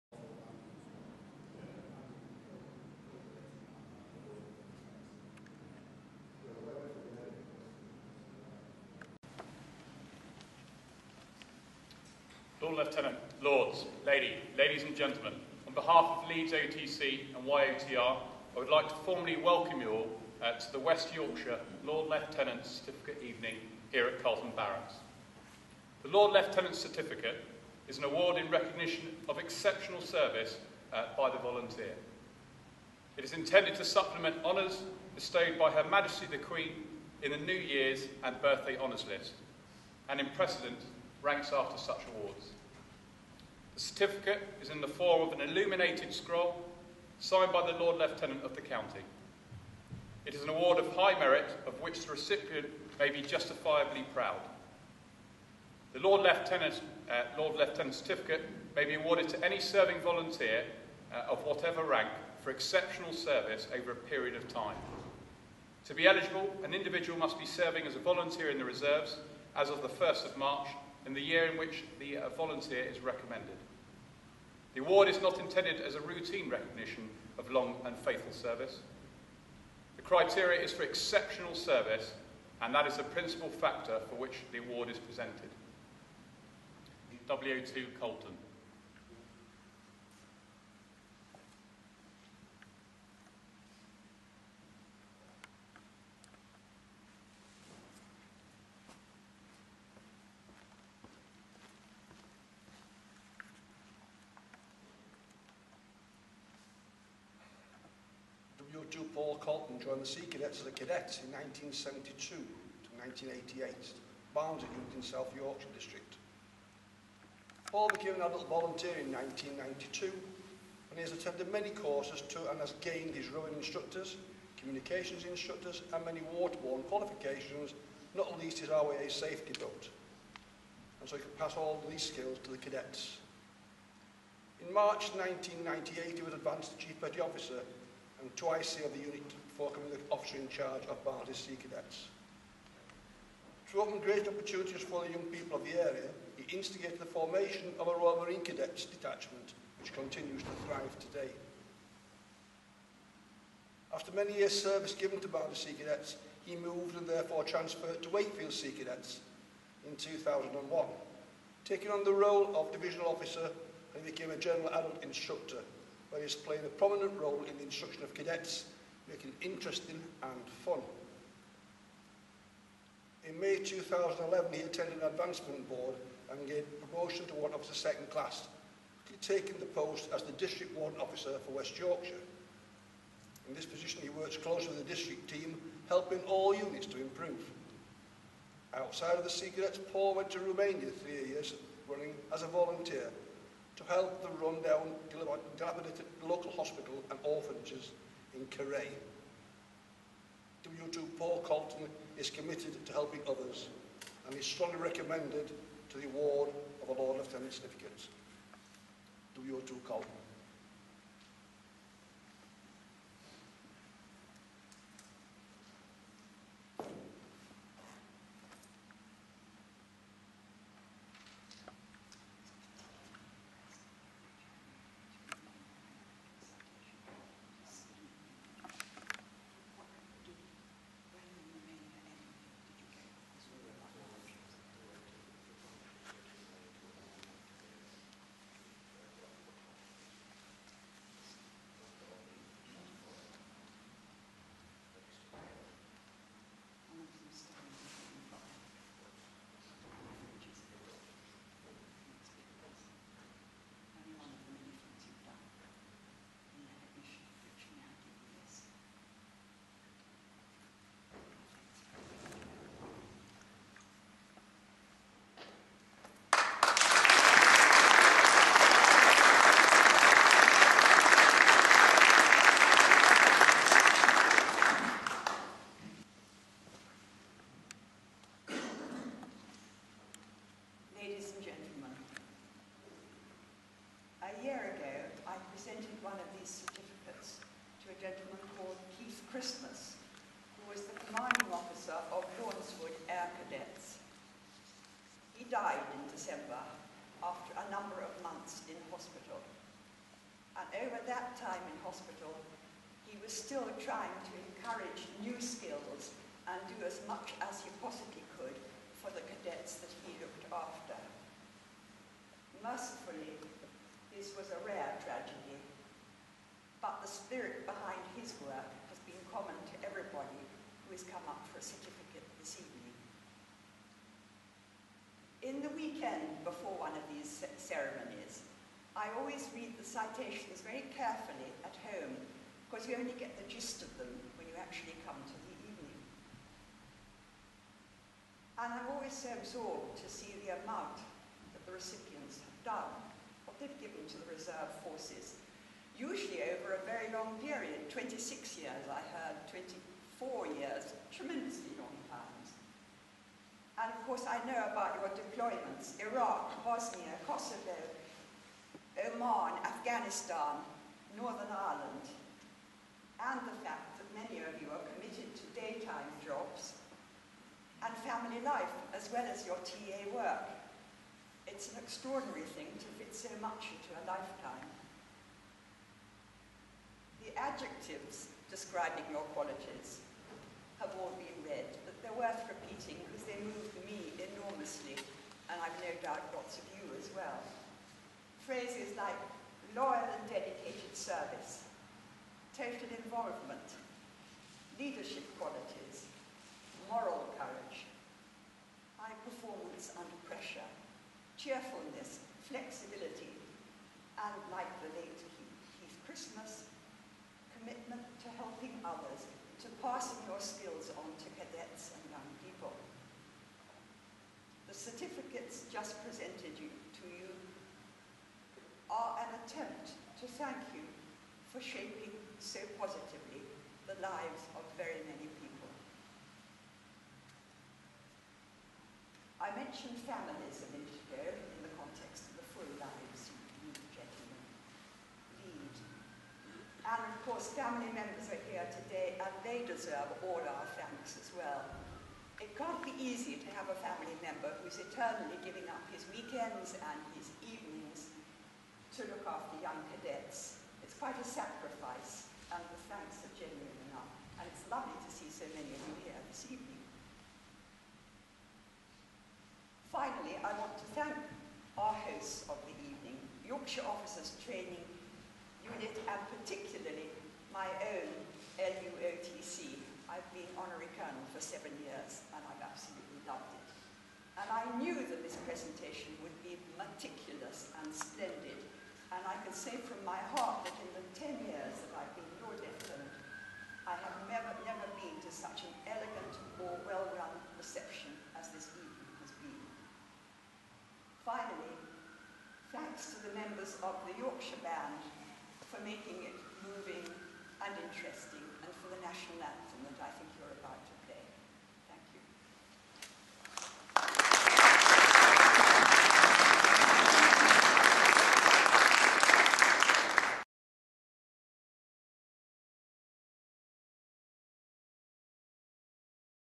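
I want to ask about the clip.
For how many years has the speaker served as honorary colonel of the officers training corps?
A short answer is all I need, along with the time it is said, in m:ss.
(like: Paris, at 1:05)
7, at 7:51.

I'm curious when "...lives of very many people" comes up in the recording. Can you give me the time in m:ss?
7:04.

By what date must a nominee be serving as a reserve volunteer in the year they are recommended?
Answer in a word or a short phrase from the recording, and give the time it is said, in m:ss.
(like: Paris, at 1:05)
1st of March, at 1:09.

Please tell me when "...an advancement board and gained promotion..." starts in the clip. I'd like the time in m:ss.
2:55.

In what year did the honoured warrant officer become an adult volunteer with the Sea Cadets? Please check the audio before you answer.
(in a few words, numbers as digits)
1992.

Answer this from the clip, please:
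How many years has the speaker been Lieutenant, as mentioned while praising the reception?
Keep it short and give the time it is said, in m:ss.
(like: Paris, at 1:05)
10, at 8:01.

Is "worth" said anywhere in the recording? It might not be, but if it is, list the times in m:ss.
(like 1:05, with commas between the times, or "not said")
6:22.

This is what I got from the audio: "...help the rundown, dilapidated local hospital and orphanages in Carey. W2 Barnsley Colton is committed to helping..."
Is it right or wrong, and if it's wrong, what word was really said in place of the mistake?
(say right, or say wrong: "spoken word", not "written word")
wrong: "Paul", not "Barnsley".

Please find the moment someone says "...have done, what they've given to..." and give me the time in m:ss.
5:42.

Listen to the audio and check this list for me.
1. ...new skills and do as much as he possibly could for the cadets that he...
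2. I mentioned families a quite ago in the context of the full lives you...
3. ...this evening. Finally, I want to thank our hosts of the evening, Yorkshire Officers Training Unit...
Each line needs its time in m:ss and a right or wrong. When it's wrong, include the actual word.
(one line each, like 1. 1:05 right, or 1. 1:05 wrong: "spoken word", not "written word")
1. 5:05 right
2. 7:09 wrong: "minute", not "quite"
3. 7:36 right.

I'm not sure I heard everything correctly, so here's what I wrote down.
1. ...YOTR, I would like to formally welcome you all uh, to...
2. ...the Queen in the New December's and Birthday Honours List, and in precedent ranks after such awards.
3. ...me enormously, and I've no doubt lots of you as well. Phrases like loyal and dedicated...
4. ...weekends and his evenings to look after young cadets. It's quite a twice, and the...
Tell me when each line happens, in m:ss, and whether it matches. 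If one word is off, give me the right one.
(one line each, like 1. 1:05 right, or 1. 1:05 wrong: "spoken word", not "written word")
1. 0:17 right
2. 0:36 wrong: "Year", not "December"
3. 6:23 right
4. 7:26 wrong: "sacrifice", not "twice".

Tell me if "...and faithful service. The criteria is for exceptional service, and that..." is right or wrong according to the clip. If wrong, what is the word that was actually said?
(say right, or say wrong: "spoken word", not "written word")
right.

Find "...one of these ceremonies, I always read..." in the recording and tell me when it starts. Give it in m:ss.
5:26.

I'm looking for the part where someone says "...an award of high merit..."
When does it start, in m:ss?
0:50.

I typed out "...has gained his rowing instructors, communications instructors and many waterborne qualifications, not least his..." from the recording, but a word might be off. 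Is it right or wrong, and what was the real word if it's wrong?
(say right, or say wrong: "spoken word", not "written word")
right.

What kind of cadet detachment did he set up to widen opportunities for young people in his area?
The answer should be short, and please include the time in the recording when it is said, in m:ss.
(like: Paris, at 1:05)
Royal Marine Cadets, at 2:27.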